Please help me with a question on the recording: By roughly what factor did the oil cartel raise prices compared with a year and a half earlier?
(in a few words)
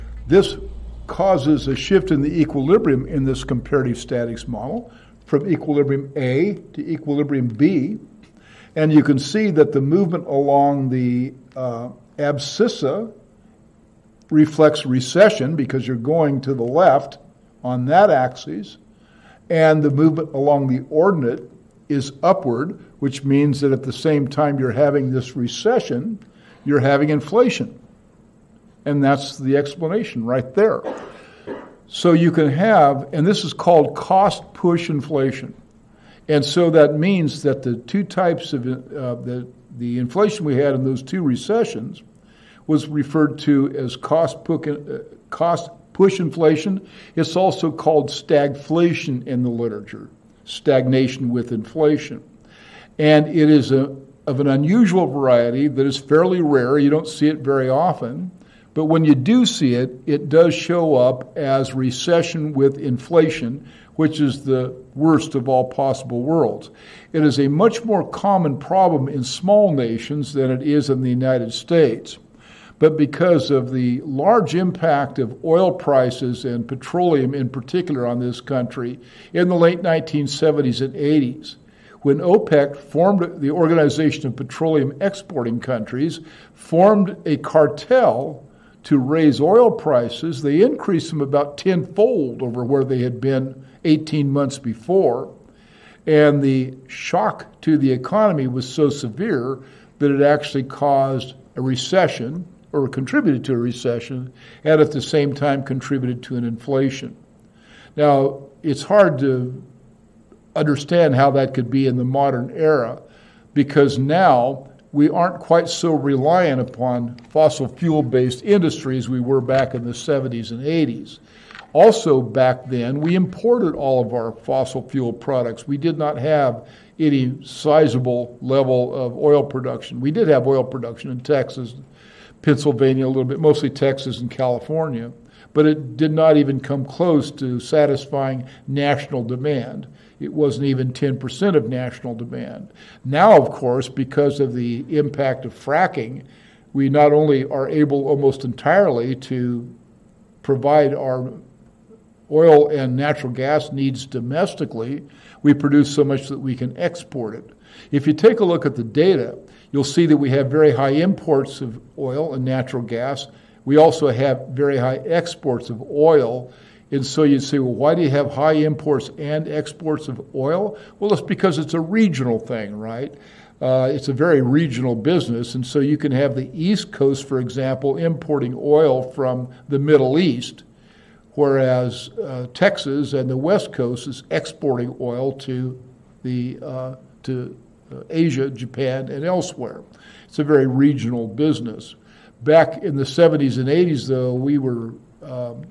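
tenfold.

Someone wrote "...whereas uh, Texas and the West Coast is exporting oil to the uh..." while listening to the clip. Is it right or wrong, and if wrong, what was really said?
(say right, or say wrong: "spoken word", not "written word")
right.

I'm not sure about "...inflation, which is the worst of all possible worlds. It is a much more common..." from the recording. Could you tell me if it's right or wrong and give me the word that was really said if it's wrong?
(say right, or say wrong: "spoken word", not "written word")
right.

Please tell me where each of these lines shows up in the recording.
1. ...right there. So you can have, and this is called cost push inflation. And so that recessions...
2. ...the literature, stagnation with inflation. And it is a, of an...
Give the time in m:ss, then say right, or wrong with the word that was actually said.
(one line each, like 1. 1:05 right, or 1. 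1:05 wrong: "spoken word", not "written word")
1. 0:30 wrong: "means", not "recessions"
2. 0:49 right.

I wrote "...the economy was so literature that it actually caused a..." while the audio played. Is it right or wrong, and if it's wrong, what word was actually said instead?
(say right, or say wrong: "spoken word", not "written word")
wrong: "severe", not "literature".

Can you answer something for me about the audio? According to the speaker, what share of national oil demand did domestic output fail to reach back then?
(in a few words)
10%.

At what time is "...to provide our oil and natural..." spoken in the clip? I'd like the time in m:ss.
2:29.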